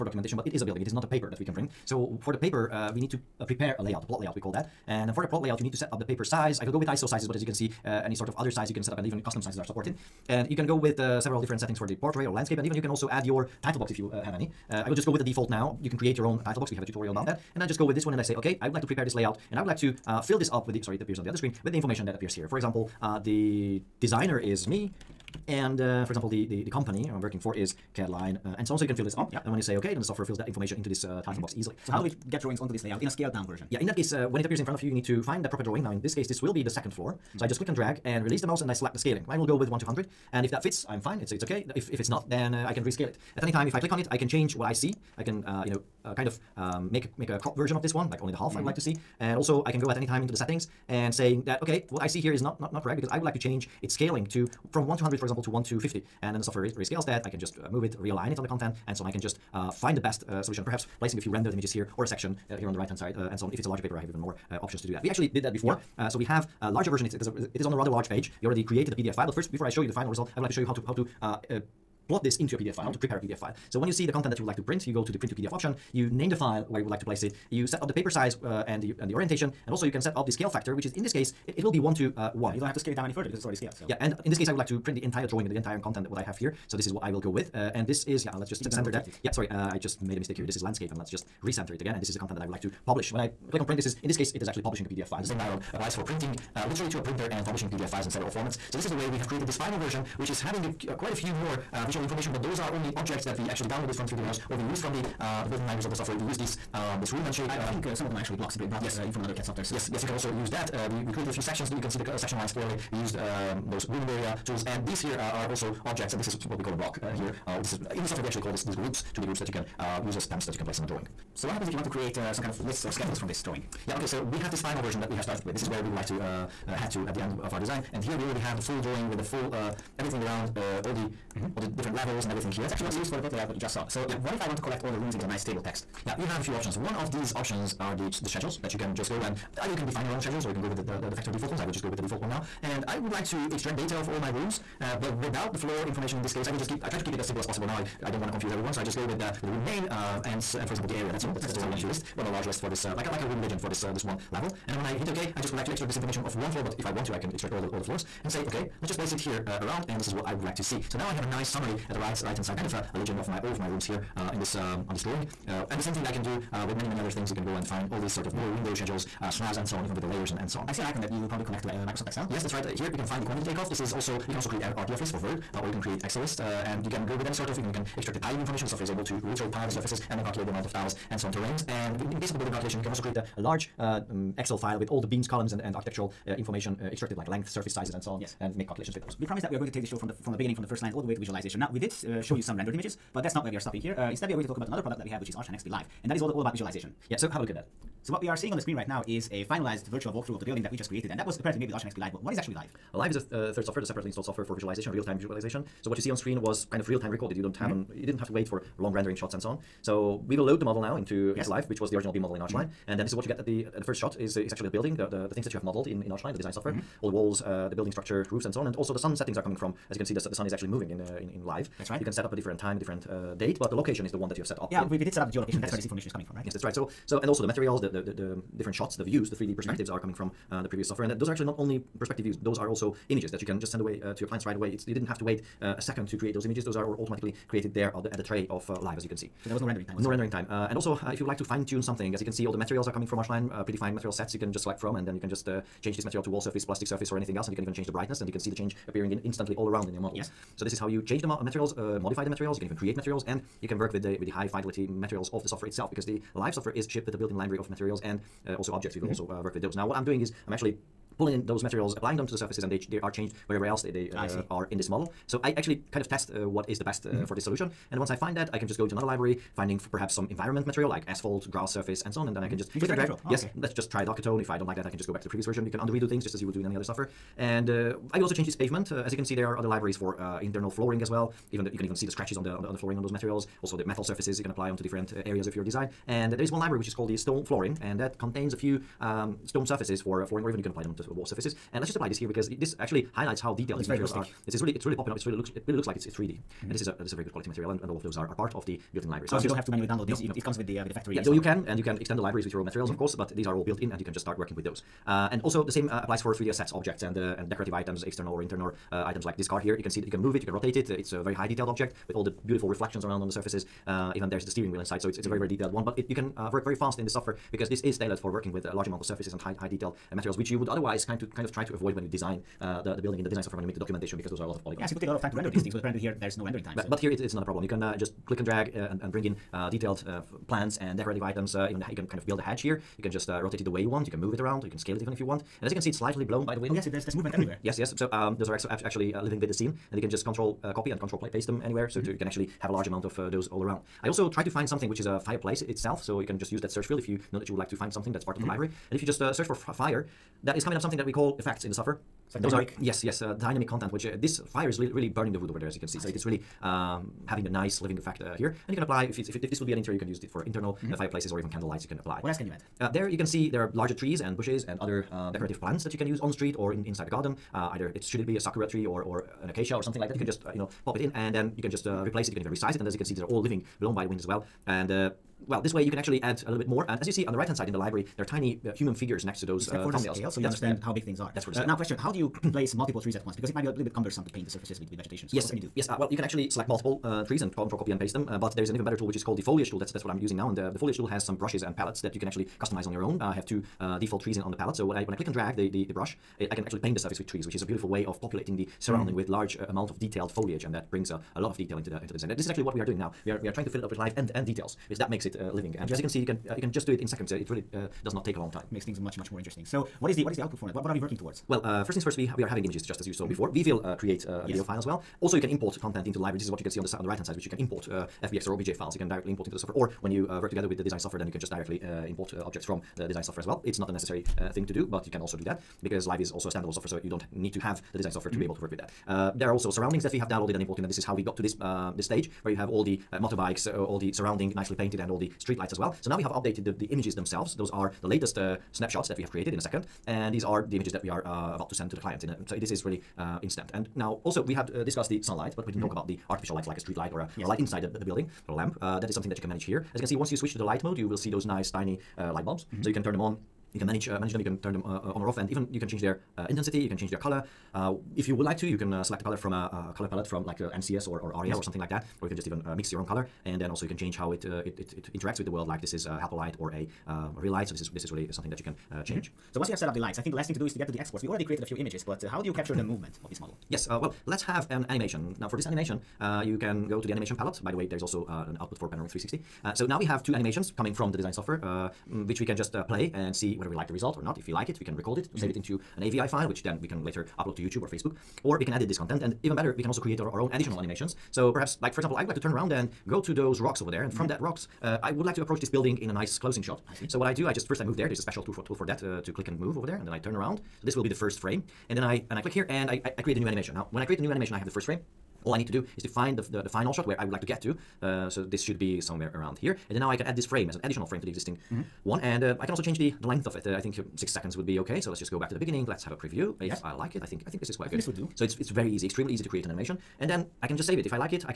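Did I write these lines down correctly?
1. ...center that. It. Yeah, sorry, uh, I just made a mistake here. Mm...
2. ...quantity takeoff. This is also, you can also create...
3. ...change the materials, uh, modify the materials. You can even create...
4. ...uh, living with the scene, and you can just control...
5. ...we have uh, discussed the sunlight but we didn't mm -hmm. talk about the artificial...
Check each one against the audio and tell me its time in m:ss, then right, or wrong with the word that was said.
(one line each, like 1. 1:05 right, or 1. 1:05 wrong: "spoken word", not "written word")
1. 1:28 right
2. 2:53 right
3. 4:11 right
4. 5:39 right
5. 7:24 right.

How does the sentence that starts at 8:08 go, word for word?
Or we can edit this content, and even better, we can also create our, our own additional animations.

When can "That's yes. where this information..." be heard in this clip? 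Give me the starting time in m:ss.
3:45.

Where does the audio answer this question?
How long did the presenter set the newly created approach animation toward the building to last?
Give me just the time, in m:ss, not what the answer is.
8:34.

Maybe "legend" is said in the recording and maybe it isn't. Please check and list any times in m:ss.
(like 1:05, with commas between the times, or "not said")
2:33, 2:42.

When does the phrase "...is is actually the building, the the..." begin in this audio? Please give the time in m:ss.
3:34.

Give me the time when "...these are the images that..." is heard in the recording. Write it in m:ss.
7:20.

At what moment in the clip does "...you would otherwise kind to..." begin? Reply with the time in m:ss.
5:20.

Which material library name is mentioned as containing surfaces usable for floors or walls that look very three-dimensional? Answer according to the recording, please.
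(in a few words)
Stone flooring.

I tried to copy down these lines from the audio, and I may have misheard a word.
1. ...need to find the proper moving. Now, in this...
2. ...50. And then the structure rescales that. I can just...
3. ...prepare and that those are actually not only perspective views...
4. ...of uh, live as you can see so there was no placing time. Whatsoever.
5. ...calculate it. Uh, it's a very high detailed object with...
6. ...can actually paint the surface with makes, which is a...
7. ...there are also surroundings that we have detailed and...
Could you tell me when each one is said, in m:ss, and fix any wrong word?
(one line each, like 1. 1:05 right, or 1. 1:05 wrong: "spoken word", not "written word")
1. 0:34 wrong: "drawing", not "moving"
2. 0:55 wrong: "software", not "structure"
3. 3:50 wrong: "software", not "prepare"
4. 3:58 wrong: "rendering", not "placing"
5. 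5:10 wrong: "rotate", not "calculate"
6. 6:36 wrong: "trees", not "makes"
7. 7:09 wrong: "downloaded", not "detailed".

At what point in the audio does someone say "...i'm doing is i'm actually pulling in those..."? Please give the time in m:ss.
4:19.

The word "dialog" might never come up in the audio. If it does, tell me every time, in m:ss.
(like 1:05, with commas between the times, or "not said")
1:35.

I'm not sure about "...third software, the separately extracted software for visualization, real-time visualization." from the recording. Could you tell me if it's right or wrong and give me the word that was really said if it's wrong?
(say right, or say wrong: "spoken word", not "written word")
wrong: "installed", not "extracted".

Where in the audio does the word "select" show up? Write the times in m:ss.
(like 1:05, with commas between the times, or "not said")
0:38, 4:04, 6:26, 7:39.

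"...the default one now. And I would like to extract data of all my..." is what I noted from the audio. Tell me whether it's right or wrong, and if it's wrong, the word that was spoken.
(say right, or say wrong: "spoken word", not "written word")
right.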